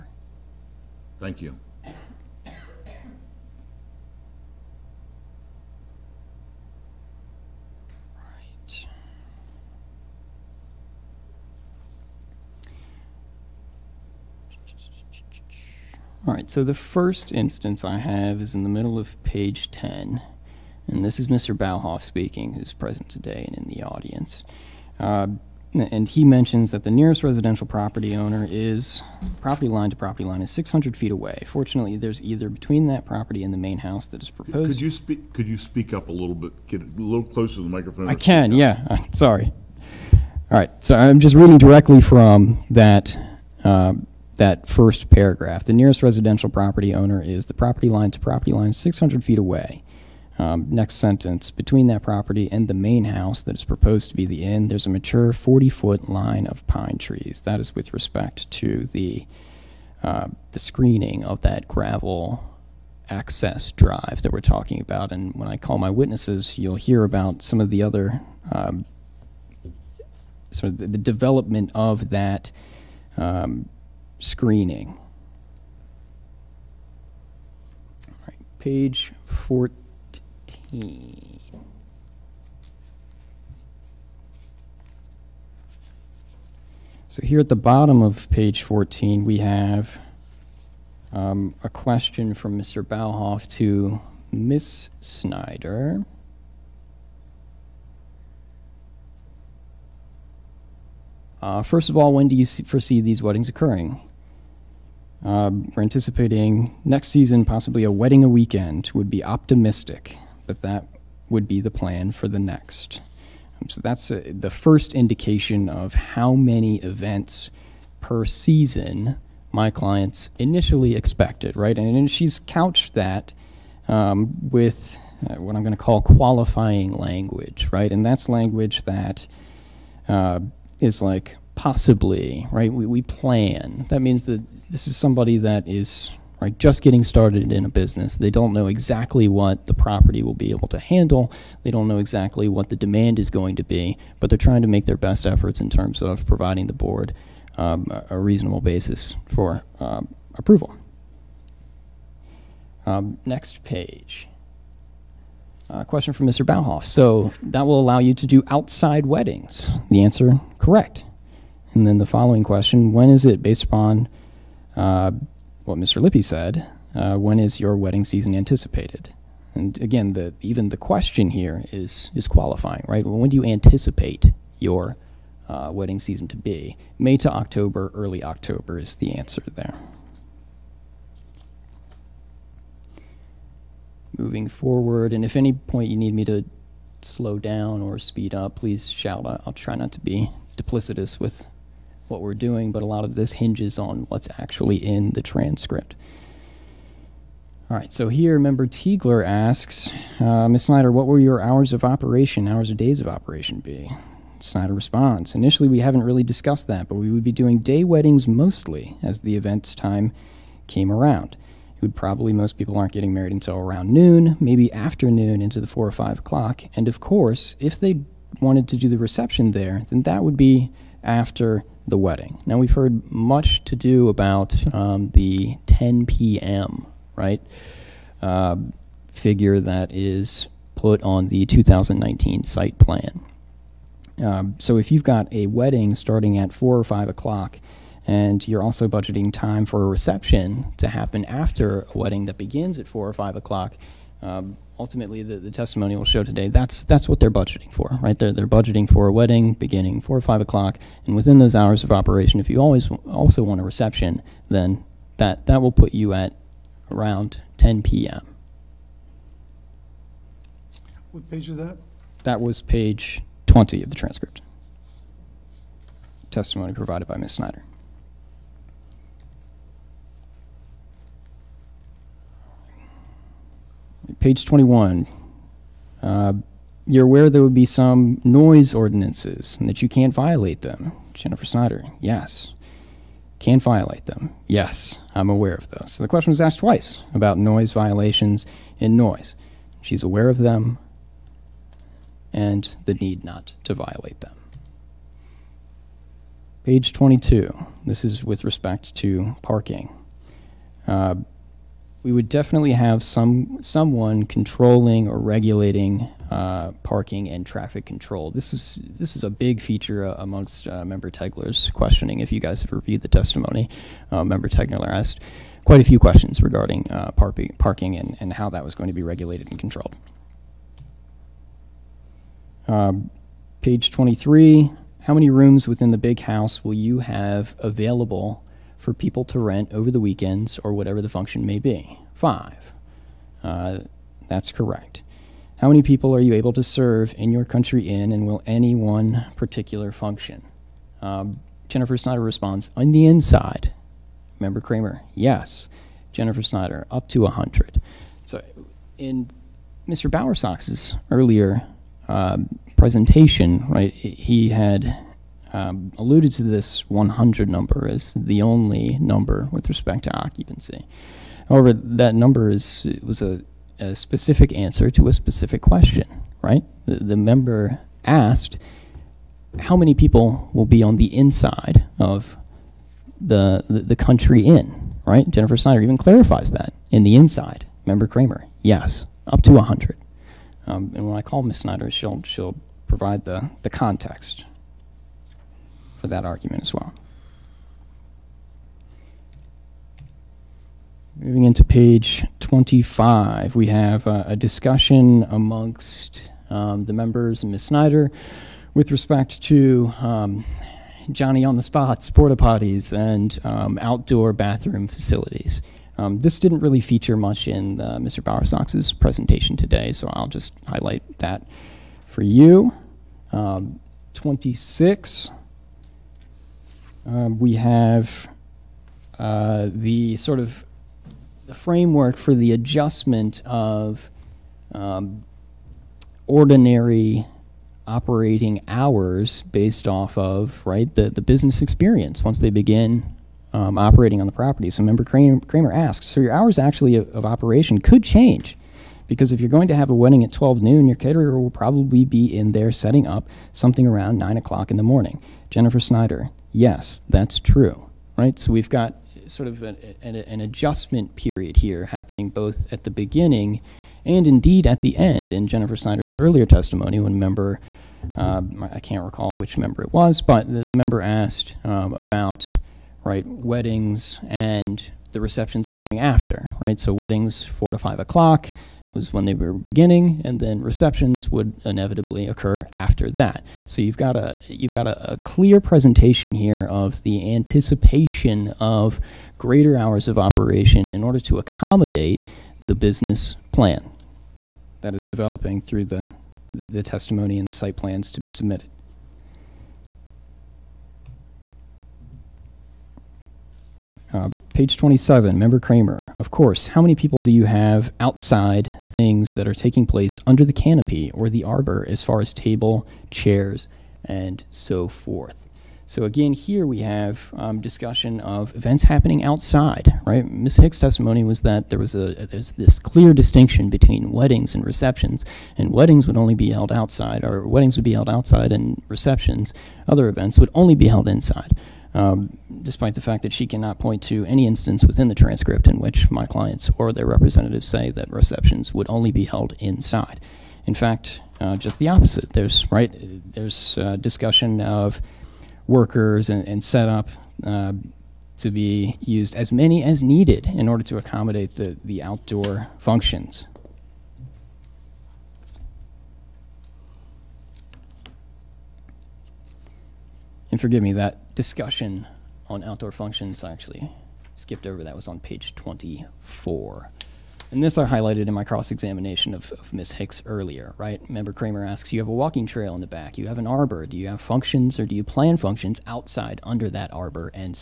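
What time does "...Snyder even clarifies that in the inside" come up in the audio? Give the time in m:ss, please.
6:15.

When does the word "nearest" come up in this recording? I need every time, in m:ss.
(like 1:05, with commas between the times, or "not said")
0:26, 0:45.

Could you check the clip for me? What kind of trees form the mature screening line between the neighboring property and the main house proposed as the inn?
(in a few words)
Pine trees.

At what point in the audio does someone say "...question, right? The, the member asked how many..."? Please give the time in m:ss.
6:05.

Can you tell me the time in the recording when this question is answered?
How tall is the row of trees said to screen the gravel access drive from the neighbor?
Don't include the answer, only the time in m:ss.
0:55.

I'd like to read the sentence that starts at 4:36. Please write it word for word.
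Uh, you're aware there would be some noise ordinances and that you can't violate them.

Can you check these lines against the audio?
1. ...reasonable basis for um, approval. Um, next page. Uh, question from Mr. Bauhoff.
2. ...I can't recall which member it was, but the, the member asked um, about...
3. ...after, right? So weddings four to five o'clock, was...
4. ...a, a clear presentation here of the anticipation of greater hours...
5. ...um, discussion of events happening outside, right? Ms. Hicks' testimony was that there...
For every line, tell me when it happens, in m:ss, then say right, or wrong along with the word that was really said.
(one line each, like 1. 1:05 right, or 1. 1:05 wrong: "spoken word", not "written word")
1. 2:28 right
2. 7:38 right
3. 7:45 right
4. 7:54 right
5. 8:27 right.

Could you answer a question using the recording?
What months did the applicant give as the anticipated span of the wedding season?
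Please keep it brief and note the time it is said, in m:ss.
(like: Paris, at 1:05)
May to October, at 2:56.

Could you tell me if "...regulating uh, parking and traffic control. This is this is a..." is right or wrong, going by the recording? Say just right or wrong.
right.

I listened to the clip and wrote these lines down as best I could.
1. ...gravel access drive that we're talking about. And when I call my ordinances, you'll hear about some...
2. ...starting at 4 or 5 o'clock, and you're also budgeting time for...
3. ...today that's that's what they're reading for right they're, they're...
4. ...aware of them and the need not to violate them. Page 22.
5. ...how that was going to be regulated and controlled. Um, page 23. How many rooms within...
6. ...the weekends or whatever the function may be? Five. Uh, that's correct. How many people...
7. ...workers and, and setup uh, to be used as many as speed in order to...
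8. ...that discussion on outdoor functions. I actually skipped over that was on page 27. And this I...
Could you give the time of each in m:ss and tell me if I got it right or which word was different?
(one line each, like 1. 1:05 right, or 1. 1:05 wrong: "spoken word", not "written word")
1. 1:01 wrong: "witnesses", not "ordinances"
2. 3:55 right
3. 4:06 wrong: "budgeting", not "reading"
4. 4:50 right
5. 5:18 right
6. 5:29 right
7. 8:55 wrong: "needed", not "speed"
8. 9:10 wrong: "24", not "27".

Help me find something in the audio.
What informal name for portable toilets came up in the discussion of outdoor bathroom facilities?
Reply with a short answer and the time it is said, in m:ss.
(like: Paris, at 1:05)
Johnny on the spots, at 6:41.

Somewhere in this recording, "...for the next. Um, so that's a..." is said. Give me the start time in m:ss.
1:52.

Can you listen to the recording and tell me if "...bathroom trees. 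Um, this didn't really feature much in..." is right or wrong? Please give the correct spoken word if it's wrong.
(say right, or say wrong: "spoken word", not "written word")
wrong: "facilities", not "trees".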